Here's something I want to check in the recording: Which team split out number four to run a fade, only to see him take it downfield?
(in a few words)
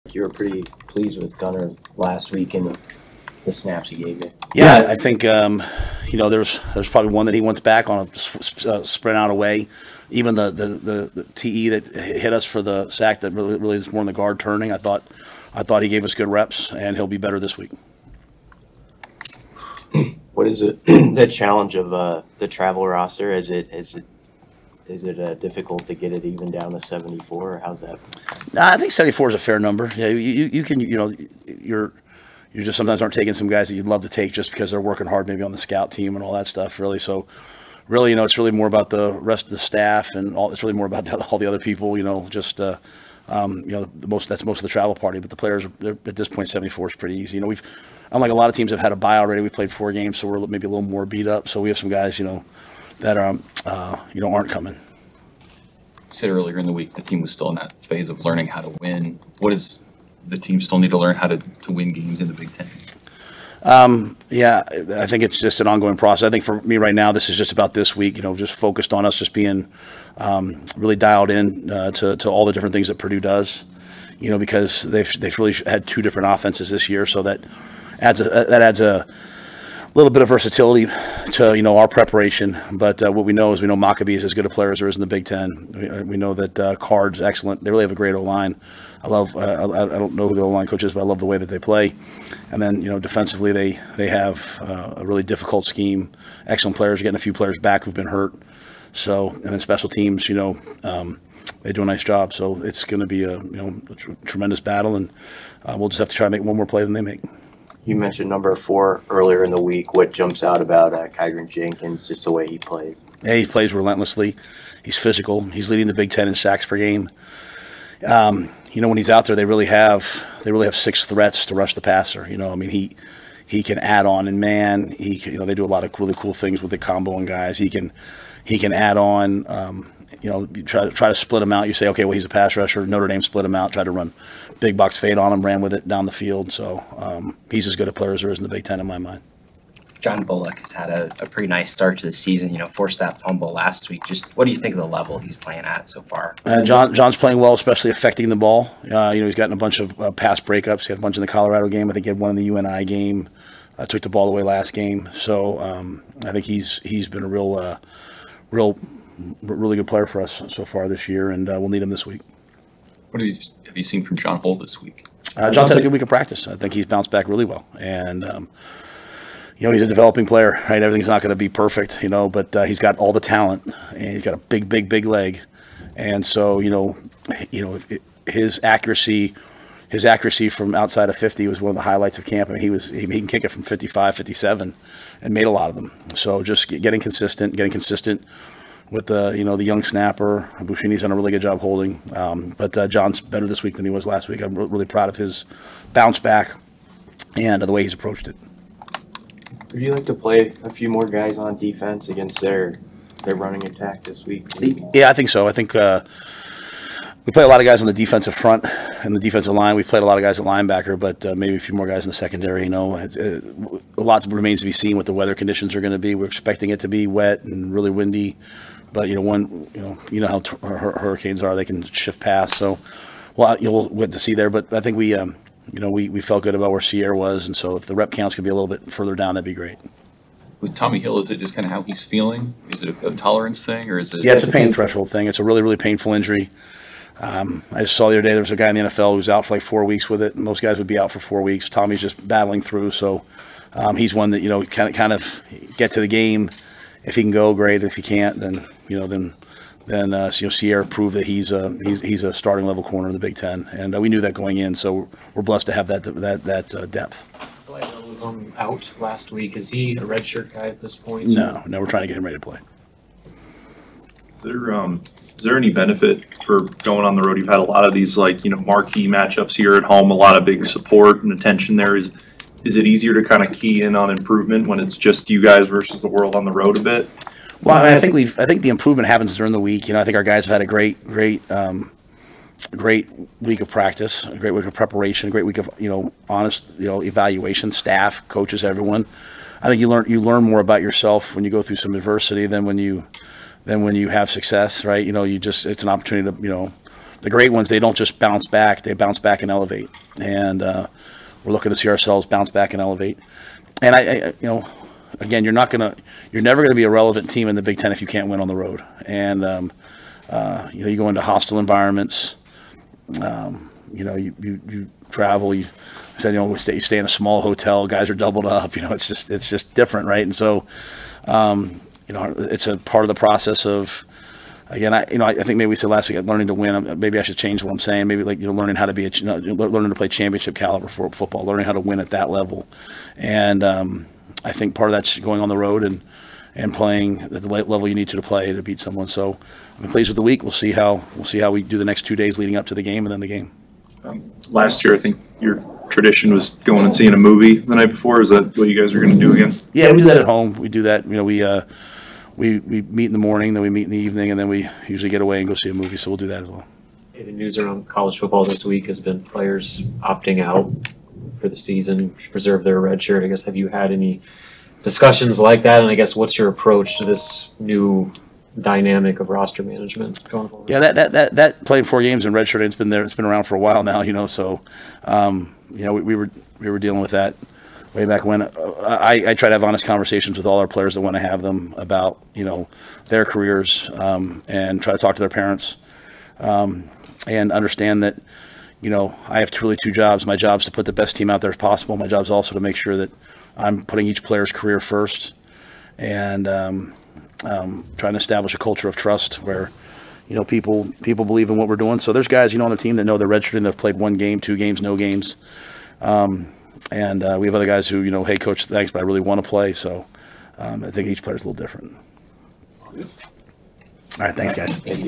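Notre Dame.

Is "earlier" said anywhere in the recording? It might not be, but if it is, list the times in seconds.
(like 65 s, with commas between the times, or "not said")
56 s, 109 s.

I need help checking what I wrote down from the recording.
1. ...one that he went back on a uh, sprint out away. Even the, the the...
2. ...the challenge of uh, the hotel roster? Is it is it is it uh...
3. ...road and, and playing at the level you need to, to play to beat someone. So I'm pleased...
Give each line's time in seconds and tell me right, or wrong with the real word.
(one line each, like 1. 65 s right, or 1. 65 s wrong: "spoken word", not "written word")
1. 7 s right
2. 20 s wrong: "travel", not "hotel"
3. 335 s right.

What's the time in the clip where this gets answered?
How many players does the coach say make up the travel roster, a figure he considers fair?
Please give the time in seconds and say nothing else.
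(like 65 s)
28 s.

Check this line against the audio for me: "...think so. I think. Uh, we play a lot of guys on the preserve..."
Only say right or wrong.
wrong.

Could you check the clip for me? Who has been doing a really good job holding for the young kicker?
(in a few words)
Buschini.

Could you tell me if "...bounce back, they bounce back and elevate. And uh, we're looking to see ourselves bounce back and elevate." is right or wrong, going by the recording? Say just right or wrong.
right.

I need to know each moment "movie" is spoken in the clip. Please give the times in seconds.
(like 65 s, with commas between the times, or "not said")
347 s, 355 s.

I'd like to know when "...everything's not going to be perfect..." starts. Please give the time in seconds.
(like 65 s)
170 s.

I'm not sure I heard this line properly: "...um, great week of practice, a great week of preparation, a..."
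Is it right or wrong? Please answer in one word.
right.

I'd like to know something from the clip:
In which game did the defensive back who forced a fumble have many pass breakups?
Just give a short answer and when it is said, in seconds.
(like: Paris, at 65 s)
Colorado game, at 151 s.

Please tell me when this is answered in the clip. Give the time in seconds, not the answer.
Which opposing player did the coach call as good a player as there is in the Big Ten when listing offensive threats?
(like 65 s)
83 s.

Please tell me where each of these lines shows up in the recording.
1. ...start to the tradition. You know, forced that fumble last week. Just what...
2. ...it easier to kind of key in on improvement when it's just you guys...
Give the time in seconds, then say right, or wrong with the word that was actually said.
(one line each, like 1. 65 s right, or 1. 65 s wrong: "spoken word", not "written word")
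1. 141 s wrong: "season", not "tradition"
2. 272 s right.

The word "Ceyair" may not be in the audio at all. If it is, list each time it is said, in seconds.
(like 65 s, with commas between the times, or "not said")
226 s, 250 s.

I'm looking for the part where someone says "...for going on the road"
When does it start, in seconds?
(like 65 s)
266 s.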